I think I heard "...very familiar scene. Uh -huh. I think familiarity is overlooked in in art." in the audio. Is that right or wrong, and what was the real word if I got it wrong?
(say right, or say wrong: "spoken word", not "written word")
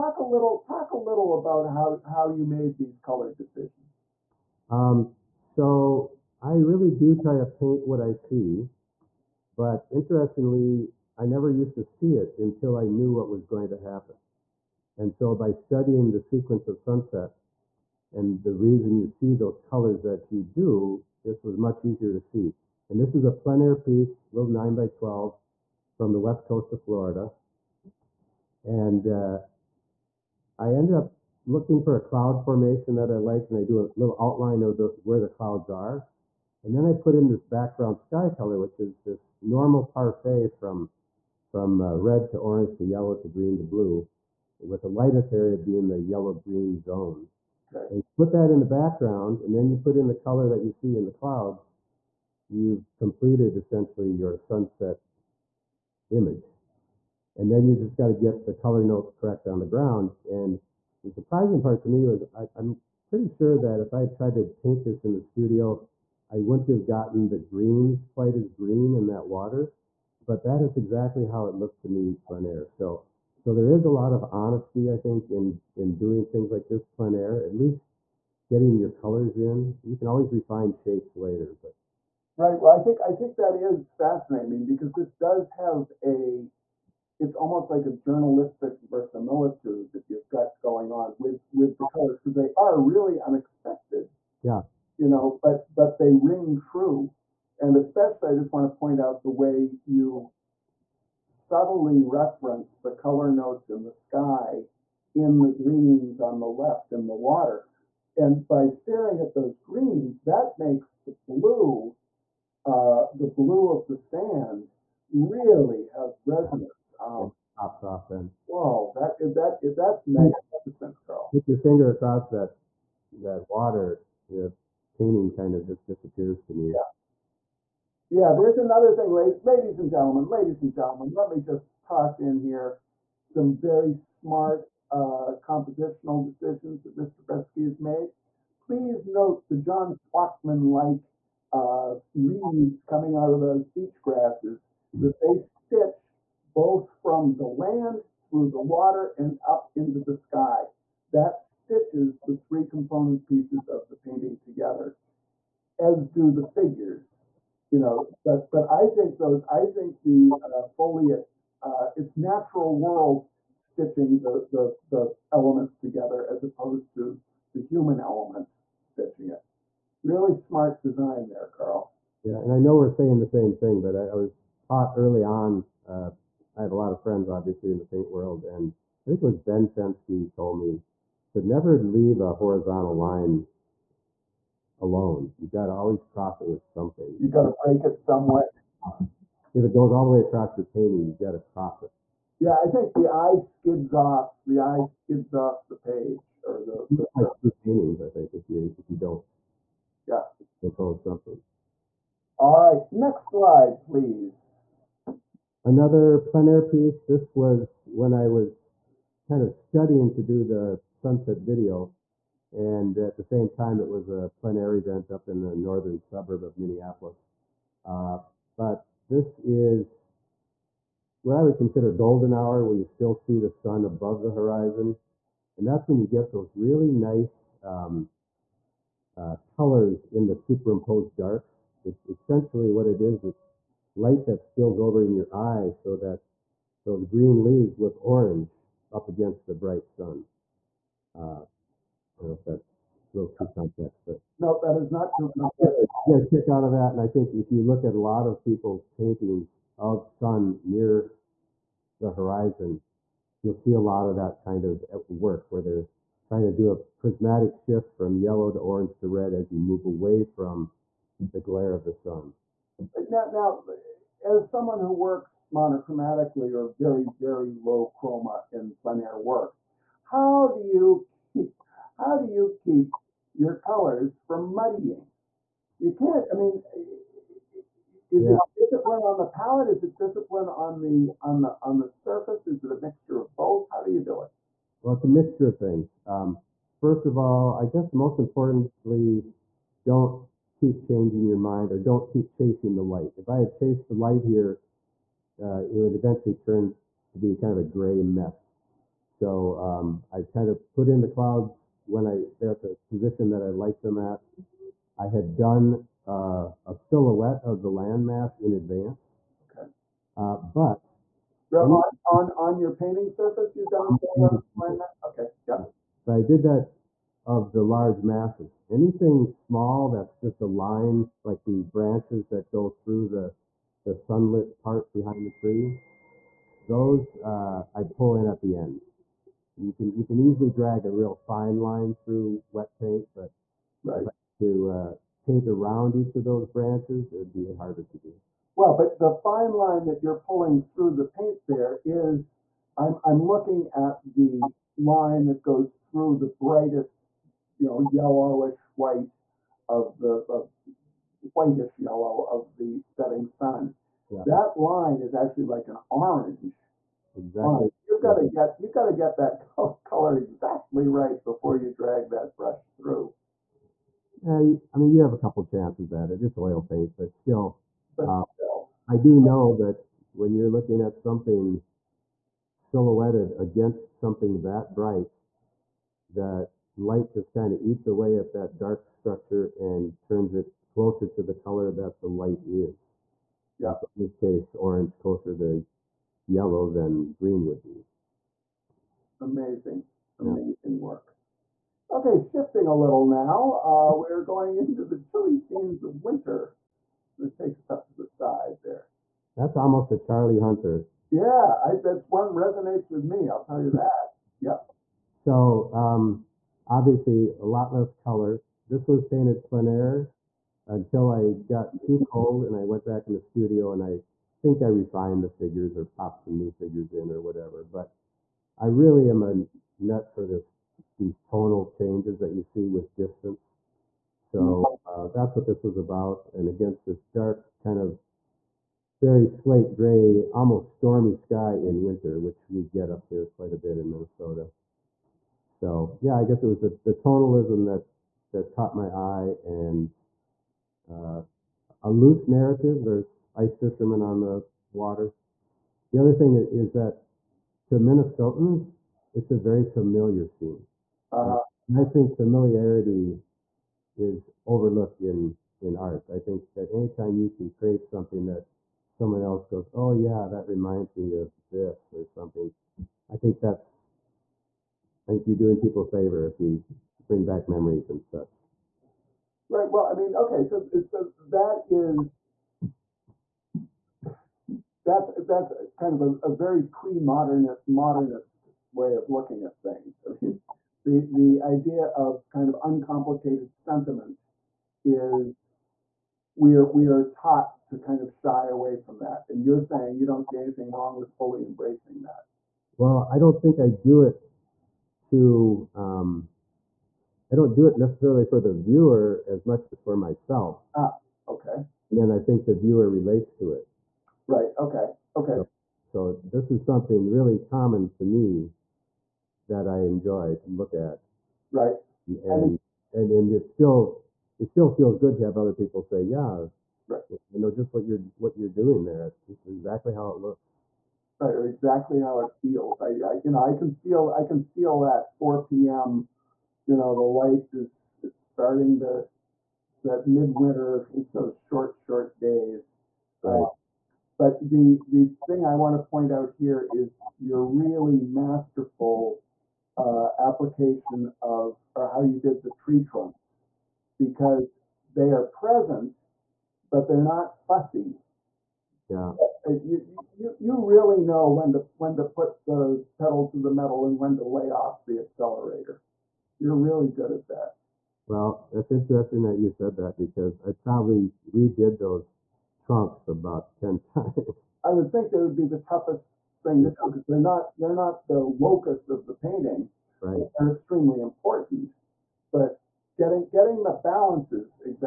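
right.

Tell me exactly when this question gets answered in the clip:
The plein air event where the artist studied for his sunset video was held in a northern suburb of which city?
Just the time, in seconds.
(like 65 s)
216 s.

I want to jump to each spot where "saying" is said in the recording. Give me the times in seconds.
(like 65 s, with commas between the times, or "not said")
172 s, 489 s.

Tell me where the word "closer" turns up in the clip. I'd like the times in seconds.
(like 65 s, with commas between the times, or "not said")
380 s, 384 s.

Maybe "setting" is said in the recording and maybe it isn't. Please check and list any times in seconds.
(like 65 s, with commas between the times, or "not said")
352 s.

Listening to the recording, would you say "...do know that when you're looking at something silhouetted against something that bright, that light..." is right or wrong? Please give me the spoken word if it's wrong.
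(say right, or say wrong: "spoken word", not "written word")
right.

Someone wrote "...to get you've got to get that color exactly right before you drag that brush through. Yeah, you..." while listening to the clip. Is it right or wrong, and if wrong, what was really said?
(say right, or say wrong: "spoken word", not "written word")
right.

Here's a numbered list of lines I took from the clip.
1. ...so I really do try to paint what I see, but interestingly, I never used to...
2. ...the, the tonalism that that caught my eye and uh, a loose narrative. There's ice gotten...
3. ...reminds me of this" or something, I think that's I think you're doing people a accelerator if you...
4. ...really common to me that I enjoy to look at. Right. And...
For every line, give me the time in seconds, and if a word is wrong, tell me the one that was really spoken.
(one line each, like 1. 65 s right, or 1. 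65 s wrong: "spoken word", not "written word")
1. 5 s right
2. 436 s wrong: "fishermen", not "gotten"
3. 460 s wrong: "favor", not "accelerator"
4. 507 s right.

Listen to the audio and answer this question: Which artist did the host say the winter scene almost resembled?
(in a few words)
Charlie Hunter.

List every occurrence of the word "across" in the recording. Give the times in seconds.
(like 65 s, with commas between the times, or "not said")
121 s, 190 s.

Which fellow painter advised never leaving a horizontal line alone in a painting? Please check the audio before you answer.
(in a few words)
Ben Fenske.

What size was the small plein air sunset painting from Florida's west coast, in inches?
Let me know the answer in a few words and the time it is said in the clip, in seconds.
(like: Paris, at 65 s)
9 by 12, at 24 s.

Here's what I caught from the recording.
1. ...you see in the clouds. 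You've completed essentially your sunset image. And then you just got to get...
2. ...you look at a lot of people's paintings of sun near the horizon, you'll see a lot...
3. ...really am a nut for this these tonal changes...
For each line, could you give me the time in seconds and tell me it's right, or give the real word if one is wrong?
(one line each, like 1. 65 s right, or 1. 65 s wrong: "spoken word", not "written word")
1. 50 s right
2. 247 s right
3. 418 s right.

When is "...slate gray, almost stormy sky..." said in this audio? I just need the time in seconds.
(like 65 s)
429 s.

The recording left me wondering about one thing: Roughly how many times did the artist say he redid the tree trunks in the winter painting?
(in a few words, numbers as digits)
10.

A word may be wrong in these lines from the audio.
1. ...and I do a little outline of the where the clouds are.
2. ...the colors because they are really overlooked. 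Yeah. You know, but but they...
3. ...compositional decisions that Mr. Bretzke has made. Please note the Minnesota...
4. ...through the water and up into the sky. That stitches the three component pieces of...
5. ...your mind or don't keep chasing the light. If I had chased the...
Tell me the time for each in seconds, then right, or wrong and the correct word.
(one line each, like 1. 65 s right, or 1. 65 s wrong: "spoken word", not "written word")
1. 33 s right
2. 91 s wrong: "unexpected", not "overlooked"
3. 135 s wrong: "John", not "Minnesota"
4. 148 s right
5. 291 s right.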